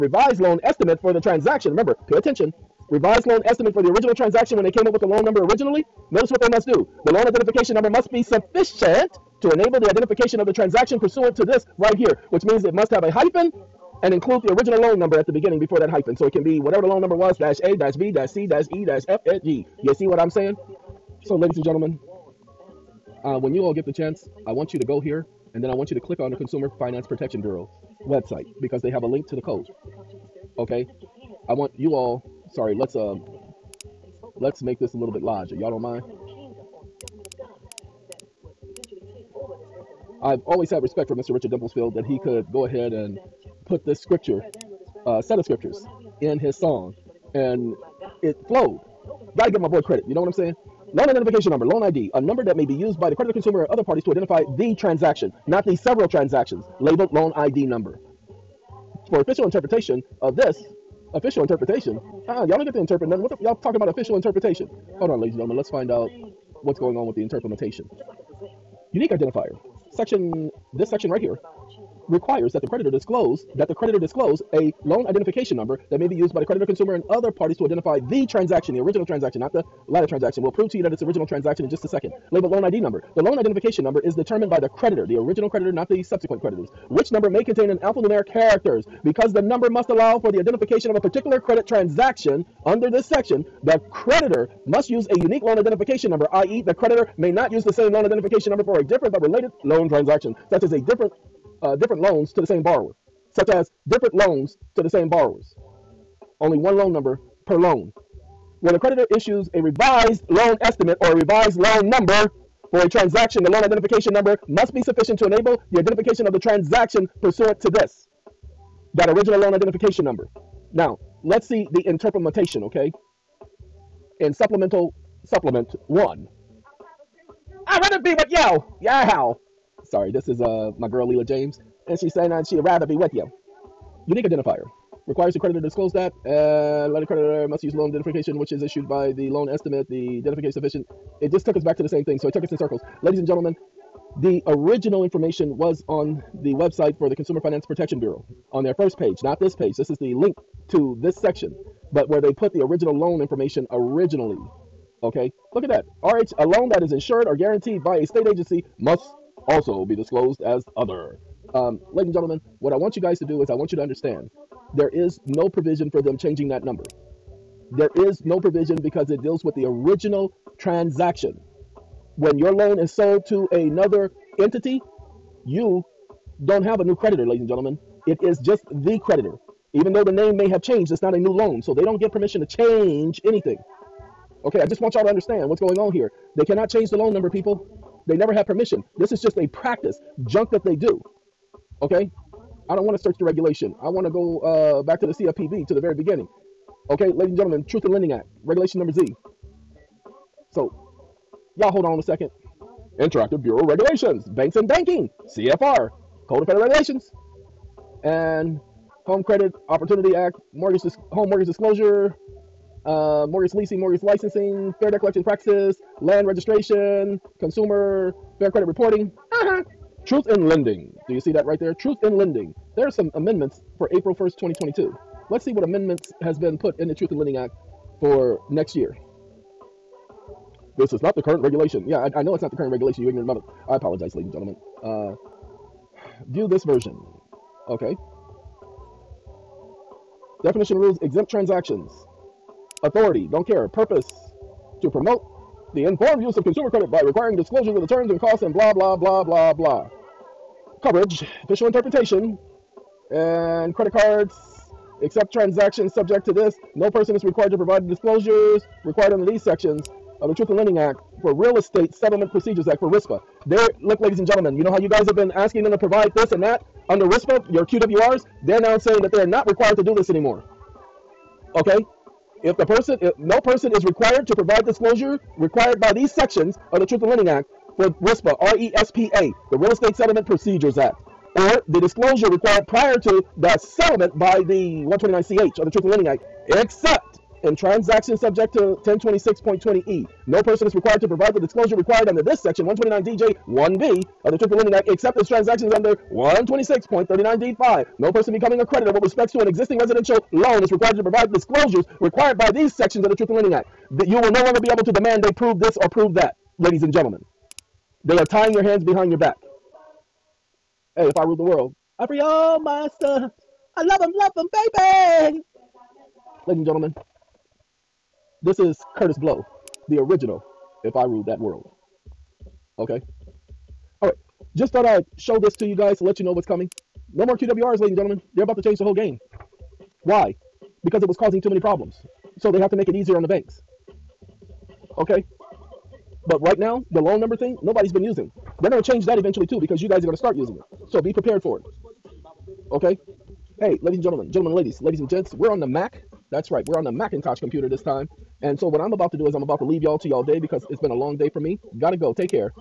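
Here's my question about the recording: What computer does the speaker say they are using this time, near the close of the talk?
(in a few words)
Macintosh.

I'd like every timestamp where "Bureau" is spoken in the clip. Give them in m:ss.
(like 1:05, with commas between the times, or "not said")
0:27, 2:27, 3:23.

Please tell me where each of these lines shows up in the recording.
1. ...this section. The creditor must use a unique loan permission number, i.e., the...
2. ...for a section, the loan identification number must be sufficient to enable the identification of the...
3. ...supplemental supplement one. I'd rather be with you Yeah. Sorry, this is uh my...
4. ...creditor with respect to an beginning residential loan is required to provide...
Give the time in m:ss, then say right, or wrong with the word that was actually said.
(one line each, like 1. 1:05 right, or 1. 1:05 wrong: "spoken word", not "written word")
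1. 1:32 wrong: "identification", not "permission"
2. 1:52 wrong: "transaction", not "section"
3. 2:04 right
4. 4:58 wrong: "existing", not "beginning".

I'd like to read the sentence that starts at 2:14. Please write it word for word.
Unique identifier requires the creditor to disclose that.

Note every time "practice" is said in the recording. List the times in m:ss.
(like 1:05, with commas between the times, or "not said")
3:09, 3:35.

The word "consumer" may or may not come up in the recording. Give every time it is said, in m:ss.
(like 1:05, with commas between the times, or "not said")
0:26, 0:53, 1:16, 2:27, 3:37, 4:06.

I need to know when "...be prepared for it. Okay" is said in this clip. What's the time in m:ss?
5:40.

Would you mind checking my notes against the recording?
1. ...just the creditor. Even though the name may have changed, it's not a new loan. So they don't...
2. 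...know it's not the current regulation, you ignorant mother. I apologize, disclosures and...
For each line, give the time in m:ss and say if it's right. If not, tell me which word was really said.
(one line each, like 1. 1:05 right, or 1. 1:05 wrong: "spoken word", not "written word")
1. 2:58 right
2. 3:52 wrong: "ladies", not "disclosures".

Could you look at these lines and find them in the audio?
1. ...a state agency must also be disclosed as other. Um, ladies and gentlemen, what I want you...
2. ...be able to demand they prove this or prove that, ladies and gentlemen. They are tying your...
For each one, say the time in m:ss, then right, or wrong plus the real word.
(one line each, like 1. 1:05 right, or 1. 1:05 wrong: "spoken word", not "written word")
1. 2:37 right
2. 5:04 right.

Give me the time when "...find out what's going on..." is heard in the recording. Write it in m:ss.
1:05.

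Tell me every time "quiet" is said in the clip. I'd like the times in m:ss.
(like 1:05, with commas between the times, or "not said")
not said.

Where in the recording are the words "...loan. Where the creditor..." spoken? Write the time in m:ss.
1:47.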